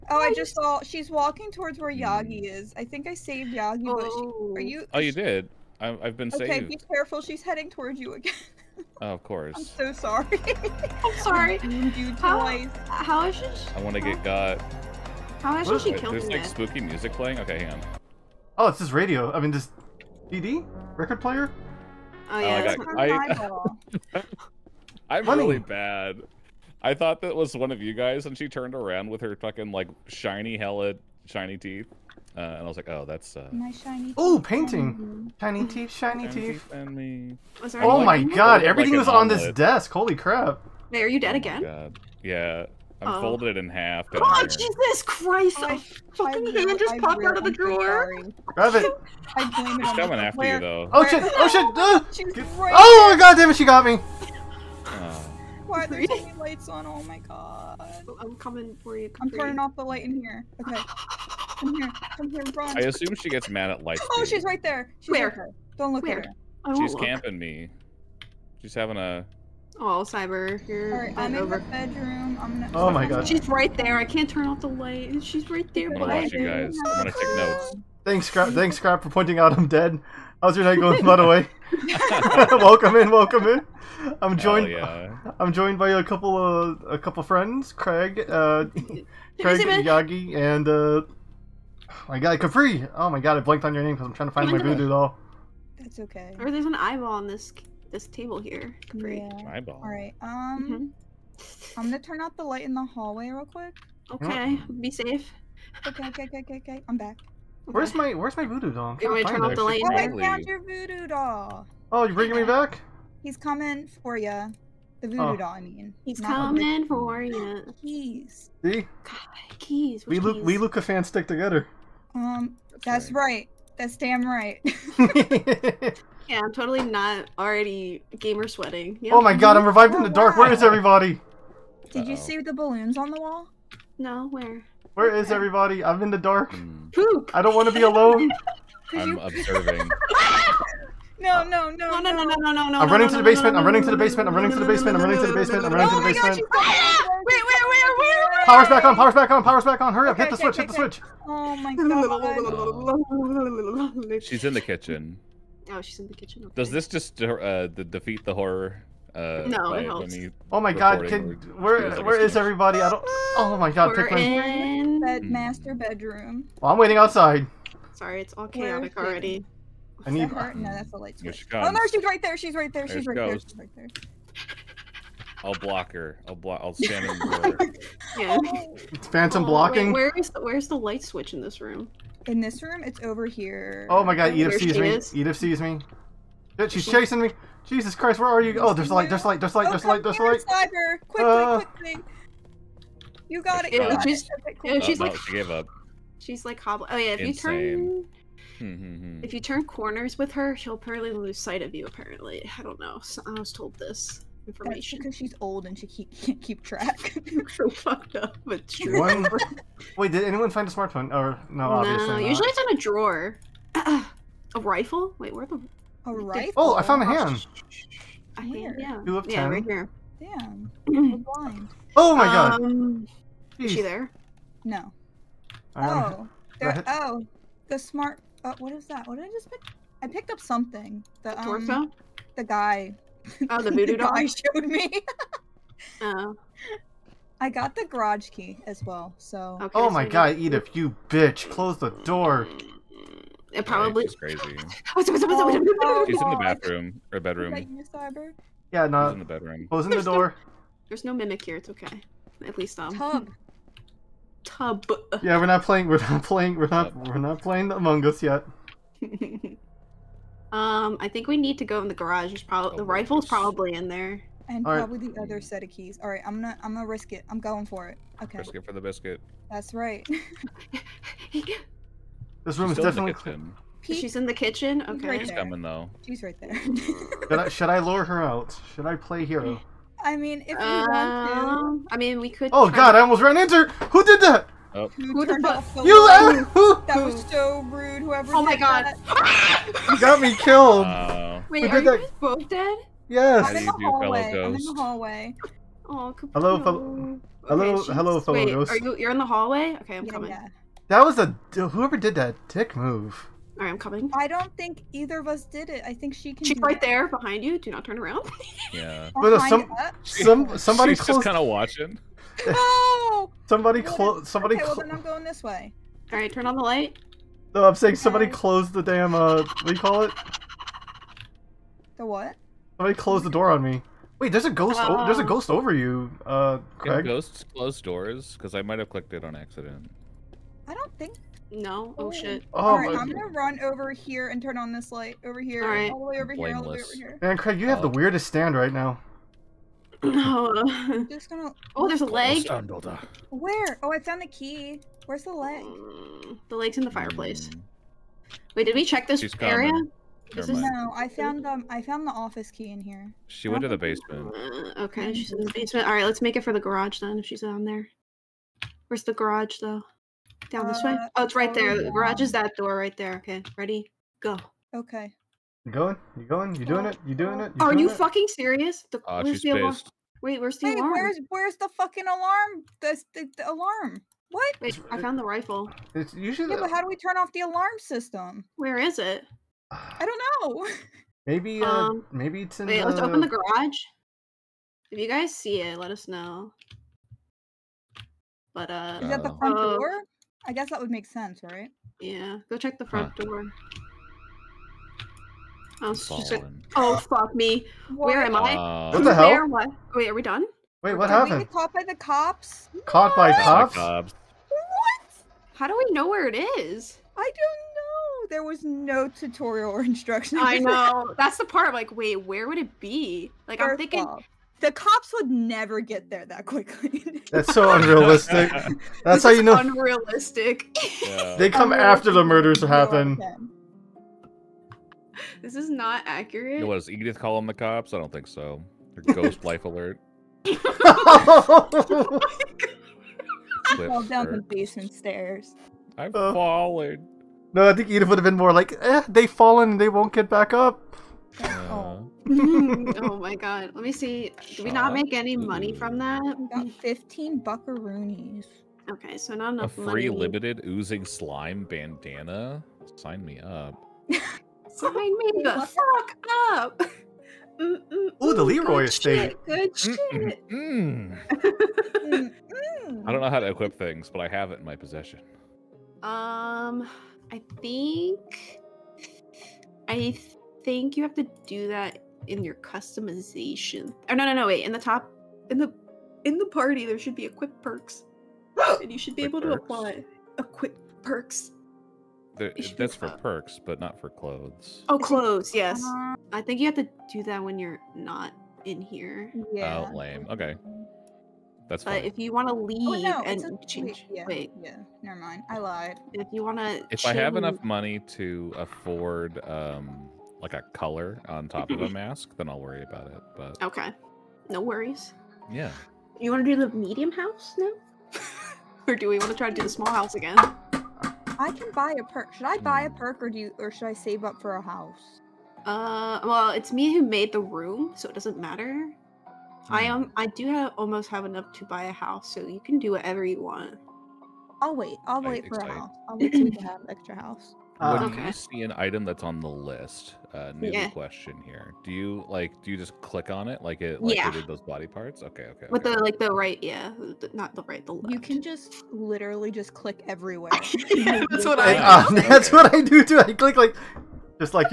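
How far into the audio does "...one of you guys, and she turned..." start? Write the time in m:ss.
0:27.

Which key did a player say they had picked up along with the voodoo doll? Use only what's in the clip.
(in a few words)
Garage key.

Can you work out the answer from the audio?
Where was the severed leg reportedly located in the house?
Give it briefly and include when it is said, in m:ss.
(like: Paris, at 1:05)
In the fireplace, at 5:46.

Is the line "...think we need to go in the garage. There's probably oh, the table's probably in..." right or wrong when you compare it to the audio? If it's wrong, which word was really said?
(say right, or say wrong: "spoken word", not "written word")
wrong: "rifle", not "table".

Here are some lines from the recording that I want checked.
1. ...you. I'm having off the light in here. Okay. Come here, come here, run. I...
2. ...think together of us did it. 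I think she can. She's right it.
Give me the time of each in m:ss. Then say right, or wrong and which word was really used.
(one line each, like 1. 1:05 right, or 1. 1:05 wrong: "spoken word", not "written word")
1. 0:58 wrong: "turning", not "having"
2. 5:04 wrong: "either", not "together".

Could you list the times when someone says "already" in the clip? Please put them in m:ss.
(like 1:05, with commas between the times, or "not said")
2:07, 2:49.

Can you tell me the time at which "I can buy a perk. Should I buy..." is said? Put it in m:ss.
8:31.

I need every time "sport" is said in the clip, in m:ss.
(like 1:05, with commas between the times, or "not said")
not said.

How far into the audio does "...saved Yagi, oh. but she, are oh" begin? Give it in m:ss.
0:03.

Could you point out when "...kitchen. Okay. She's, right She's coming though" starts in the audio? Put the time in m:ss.
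4:34.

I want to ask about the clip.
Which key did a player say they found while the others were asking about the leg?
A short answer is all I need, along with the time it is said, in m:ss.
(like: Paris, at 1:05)
The office key, at 5:52.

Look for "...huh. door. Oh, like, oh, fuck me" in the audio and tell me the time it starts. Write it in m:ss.
6:33.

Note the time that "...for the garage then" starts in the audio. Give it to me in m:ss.
5:56.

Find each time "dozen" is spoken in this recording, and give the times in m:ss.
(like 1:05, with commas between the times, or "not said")
not said.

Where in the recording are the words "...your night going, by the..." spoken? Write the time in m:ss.
1:20.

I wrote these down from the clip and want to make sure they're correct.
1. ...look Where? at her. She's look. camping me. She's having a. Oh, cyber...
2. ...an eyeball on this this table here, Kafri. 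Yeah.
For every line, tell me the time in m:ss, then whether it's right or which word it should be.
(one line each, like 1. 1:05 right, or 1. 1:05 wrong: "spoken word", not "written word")
1. 1:05 right
2. 1:36 right.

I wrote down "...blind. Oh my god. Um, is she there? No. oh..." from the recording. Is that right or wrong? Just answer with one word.
right.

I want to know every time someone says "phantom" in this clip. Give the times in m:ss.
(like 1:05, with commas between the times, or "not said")
2:59.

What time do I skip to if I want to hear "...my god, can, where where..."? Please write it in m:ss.
2:40.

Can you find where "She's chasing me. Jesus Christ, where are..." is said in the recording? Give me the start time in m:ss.
3:06.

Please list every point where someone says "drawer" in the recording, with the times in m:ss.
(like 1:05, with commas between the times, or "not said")
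0:47, 3:32.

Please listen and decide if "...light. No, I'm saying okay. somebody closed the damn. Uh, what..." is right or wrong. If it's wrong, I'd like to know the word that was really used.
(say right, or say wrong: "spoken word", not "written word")
right.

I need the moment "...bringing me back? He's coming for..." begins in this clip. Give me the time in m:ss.
1:52.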